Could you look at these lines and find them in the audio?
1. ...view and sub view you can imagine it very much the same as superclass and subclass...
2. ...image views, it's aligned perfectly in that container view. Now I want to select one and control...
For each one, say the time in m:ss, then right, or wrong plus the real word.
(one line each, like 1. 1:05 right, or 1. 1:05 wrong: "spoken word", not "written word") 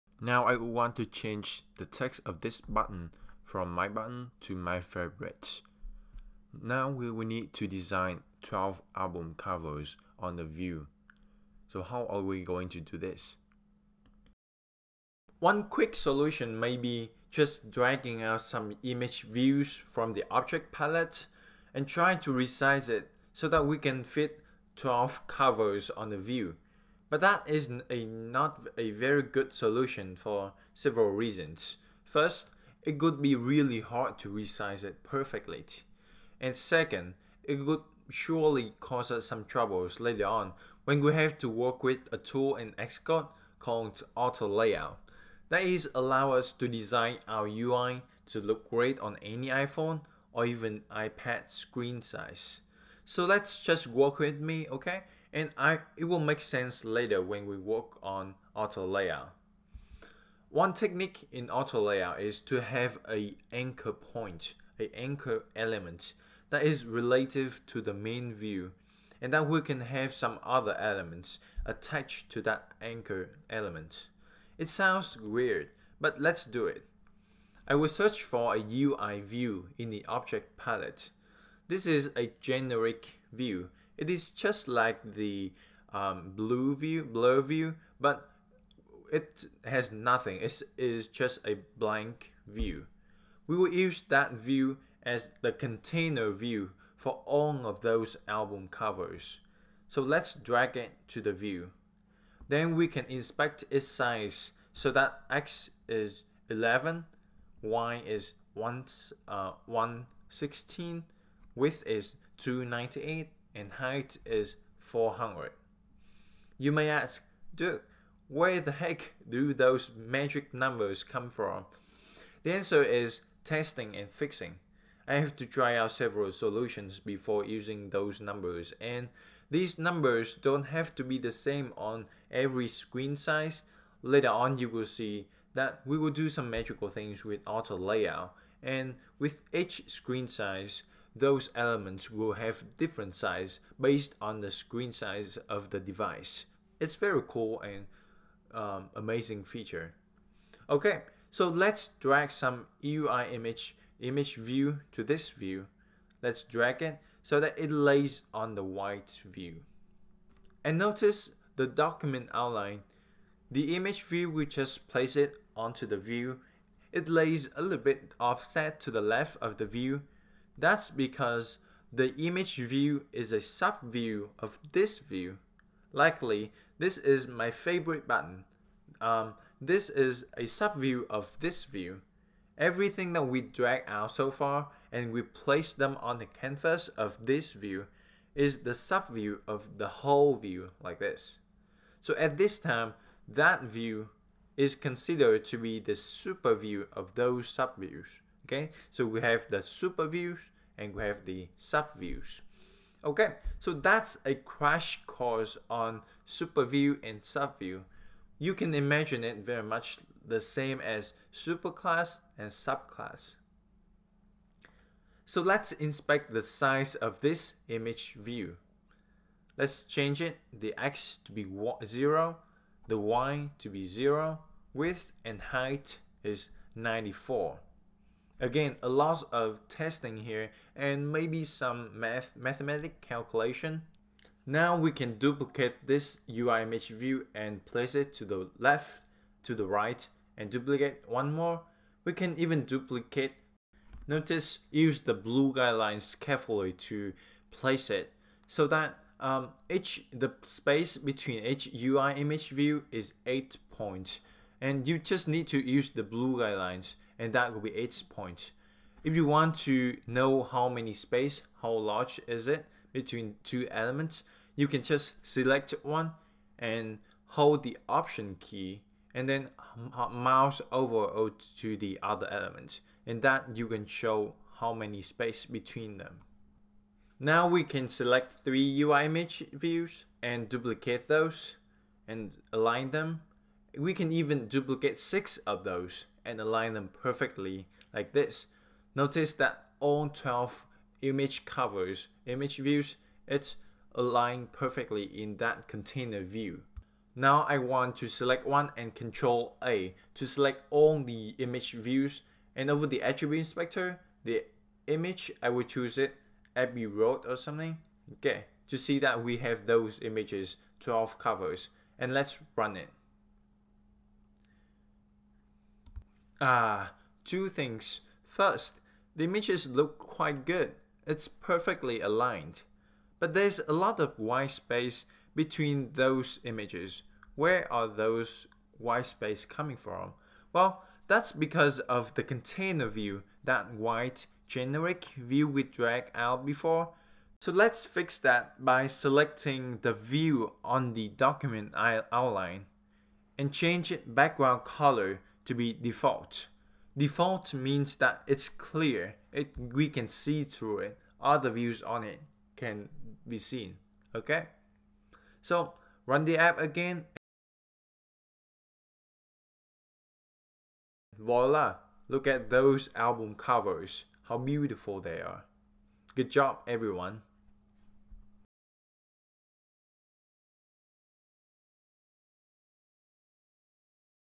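1. 3:26 right
2. 4:52 right.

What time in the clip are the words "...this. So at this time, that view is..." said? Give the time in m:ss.
3:10.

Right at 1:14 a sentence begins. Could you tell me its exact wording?
It sounds weird, but let's do it.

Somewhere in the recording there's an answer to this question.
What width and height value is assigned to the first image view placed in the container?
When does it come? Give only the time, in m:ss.
3:46.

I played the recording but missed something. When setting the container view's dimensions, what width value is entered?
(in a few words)
298.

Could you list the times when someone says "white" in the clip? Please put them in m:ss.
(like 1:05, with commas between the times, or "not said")
2:38, 5:24, 5:28, 5:33.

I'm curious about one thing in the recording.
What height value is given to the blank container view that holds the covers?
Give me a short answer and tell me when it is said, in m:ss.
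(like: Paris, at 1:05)
400, at 1:54.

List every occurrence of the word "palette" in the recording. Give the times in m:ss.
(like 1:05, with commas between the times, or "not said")
0:20, 1:20.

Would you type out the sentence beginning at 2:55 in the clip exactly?
Likely, this is my favorite button.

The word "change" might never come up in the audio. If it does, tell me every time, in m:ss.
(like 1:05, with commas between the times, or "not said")
0:01, 3:39, 5:43.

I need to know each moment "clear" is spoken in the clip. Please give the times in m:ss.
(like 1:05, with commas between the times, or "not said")
5:48.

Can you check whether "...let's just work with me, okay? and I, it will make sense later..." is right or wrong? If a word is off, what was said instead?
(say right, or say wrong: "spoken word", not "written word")
right.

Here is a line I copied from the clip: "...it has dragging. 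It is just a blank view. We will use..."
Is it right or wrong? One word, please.
wrong.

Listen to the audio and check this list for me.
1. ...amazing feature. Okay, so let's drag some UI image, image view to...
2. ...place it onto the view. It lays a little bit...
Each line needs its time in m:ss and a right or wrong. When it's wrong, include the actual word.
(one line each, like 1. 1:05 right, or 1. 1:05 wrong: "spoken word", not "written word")
1. 2:28 right
2. 2:44 right.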